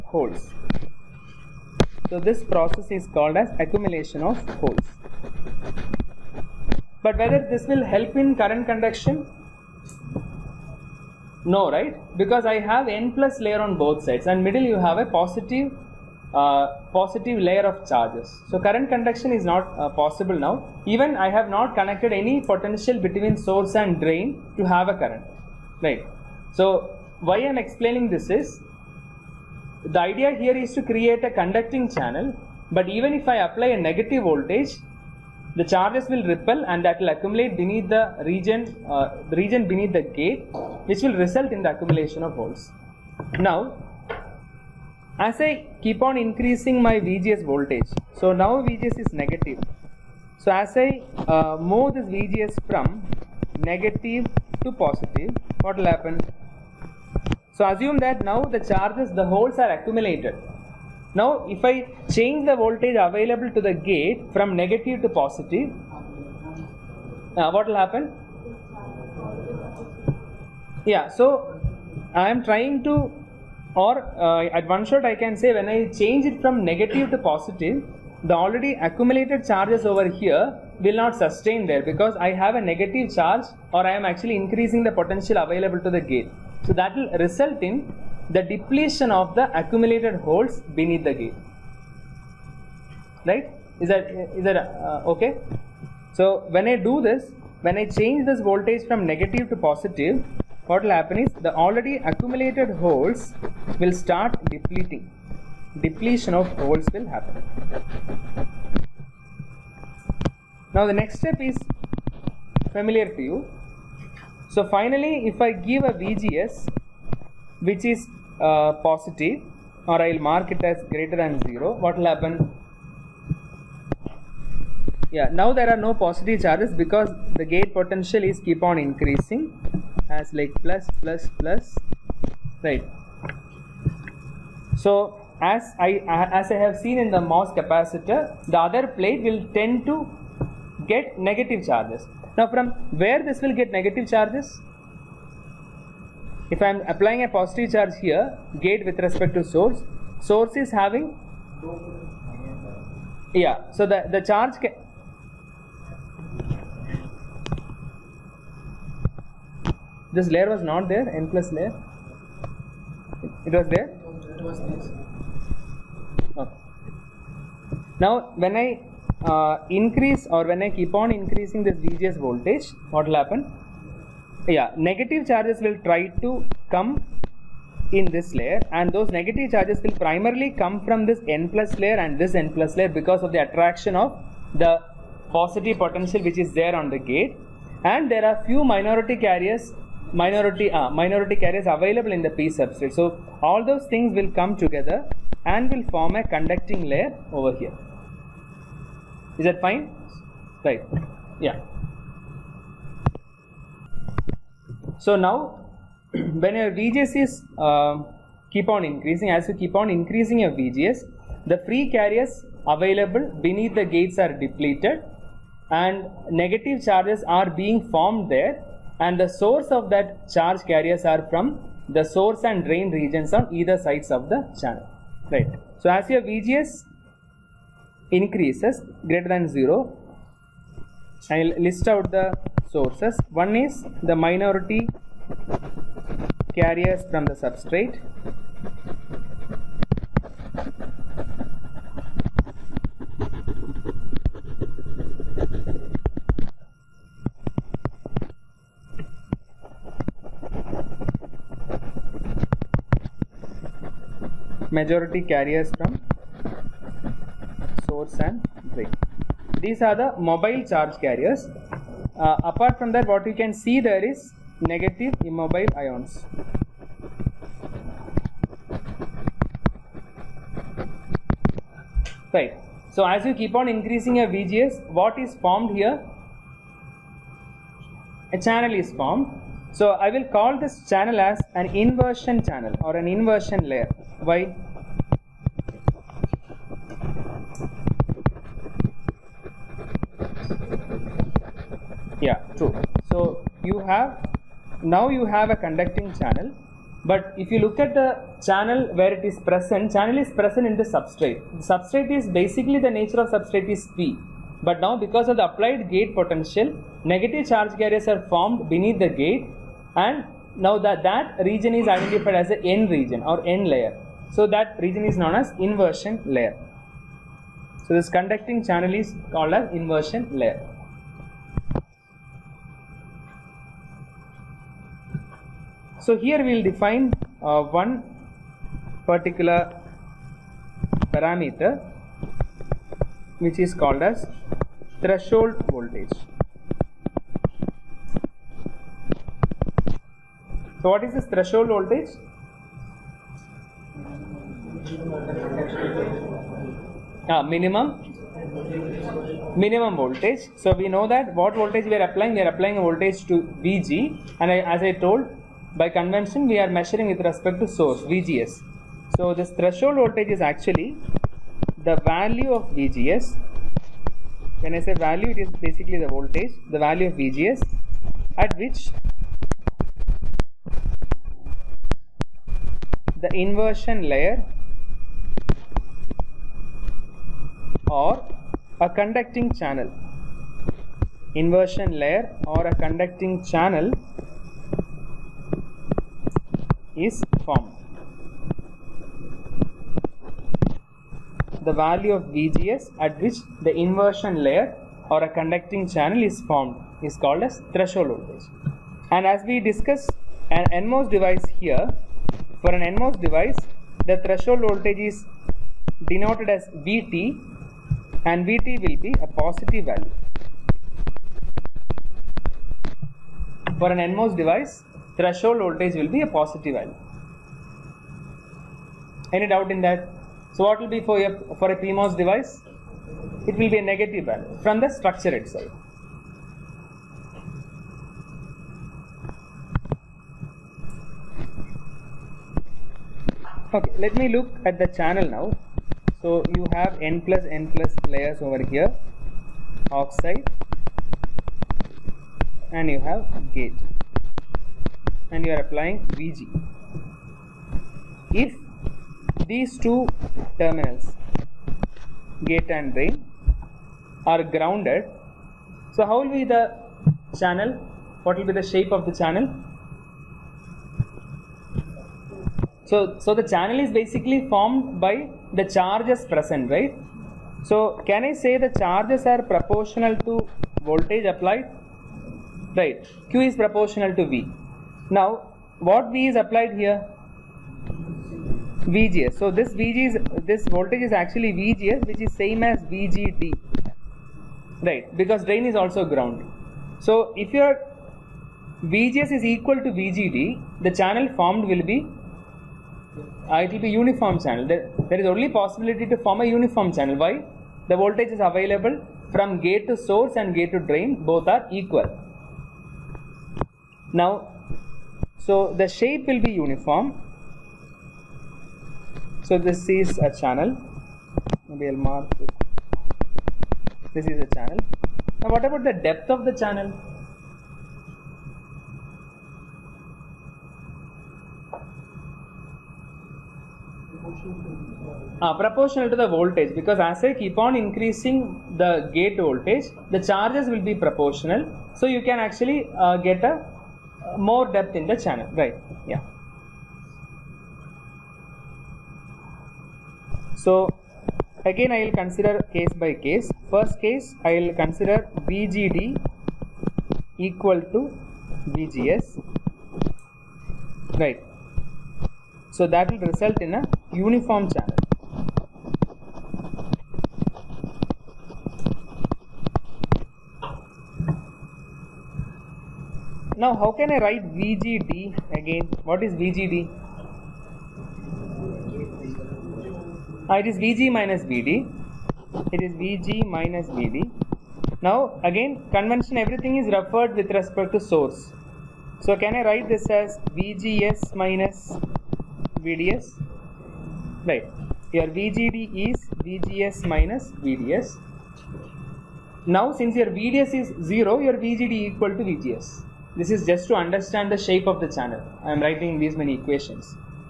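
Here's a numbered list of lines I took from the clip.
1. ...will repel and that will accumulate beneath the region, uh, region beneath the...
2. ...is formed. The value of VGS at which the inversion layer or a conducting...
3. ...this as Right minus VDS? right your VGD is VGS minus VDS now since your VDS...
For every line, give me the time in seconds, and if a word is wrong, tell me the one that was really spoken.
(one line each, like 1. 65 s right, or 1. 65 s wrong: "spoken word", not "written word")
1. 36 s right
2. 386 s right
3. 579 s wrong: "VGS", not "Right".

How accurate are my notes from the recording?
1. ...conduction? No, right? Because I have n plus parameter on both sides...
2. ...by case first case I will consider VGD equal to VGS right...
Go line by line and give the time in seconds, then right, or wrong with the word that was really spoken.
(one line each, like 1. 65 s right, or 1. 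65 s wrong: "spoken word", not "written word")
1. 8 s wrong: "layer", not "parameter"
2. 543 s right.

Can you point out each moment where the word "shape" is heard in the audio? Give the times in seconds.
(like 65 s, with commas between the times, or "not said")
458 s, 505 s, 594 s.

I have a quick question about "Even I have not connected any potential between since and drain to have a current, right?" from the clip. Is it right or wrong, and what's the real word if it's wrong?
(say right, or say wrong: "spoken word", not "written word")
wrong: "source", not "since".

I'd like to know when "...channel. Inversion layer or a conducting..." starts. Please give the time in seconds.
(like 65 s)
379 s.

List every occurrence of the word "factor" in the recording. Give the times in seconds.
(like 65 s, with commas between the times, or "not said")
not said.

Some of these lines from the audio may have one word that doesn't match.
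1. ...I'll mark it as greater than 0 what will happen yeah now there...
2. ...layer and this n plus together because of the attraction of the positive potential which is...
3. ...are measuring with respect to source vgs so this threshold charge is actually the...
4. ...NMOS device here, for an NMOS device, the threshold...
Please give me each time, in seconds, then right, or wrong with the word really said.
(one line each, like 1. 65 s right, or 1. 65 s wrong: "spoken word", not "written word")
1. 120 s right
2. 181 s wrong: "layer", not "together"
3. 356 s wrong: "voltage", not "charge"
4. 400 s right.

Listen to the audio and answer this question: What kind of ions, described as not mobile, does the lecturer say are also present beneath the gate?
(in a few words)
negative immobile ions.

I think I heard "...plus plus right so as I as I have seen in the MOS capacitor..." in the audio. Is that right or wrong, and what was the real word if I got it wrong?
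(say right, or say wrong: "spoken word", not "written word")
right.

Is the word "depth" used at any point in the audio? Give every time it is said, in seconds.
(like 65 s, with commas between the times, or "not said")
515 s, 534 s.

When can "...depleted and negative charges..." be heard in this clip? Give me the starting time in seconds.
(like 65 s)
214 s.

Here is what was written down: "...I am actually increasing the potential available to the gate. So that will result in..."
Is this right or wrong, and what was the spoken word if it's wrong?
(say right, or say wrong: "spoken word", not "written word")
right.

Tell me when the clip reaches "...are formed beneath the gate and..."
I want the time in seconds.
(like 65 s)
308 s.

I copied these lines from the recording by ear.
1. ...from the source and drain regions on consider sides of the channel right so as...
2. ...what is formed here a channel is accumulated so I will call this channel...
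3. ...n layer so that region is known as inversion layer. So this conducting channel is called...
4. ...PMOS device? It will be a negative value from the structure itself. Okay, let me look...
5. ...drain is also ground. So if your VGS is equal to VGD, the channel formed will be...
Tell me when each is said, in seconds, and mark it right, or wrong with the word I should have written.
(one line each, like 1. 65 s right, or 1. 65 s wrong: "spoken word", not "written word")
1. 221 s wrong: "either", not "consider"
2. 274 s wrong: "formed", not "accumulated"
3. 313 s right
4. 421 s right
5. 485 s right.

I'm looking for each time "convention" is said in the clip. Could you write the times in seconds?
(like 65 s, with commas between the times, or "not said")
355 s, 575 s.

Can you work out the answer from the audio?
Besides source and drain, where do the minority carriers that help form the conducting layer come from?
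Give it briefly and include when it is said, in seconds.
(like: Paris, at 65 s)
the p substrate, at 192 s.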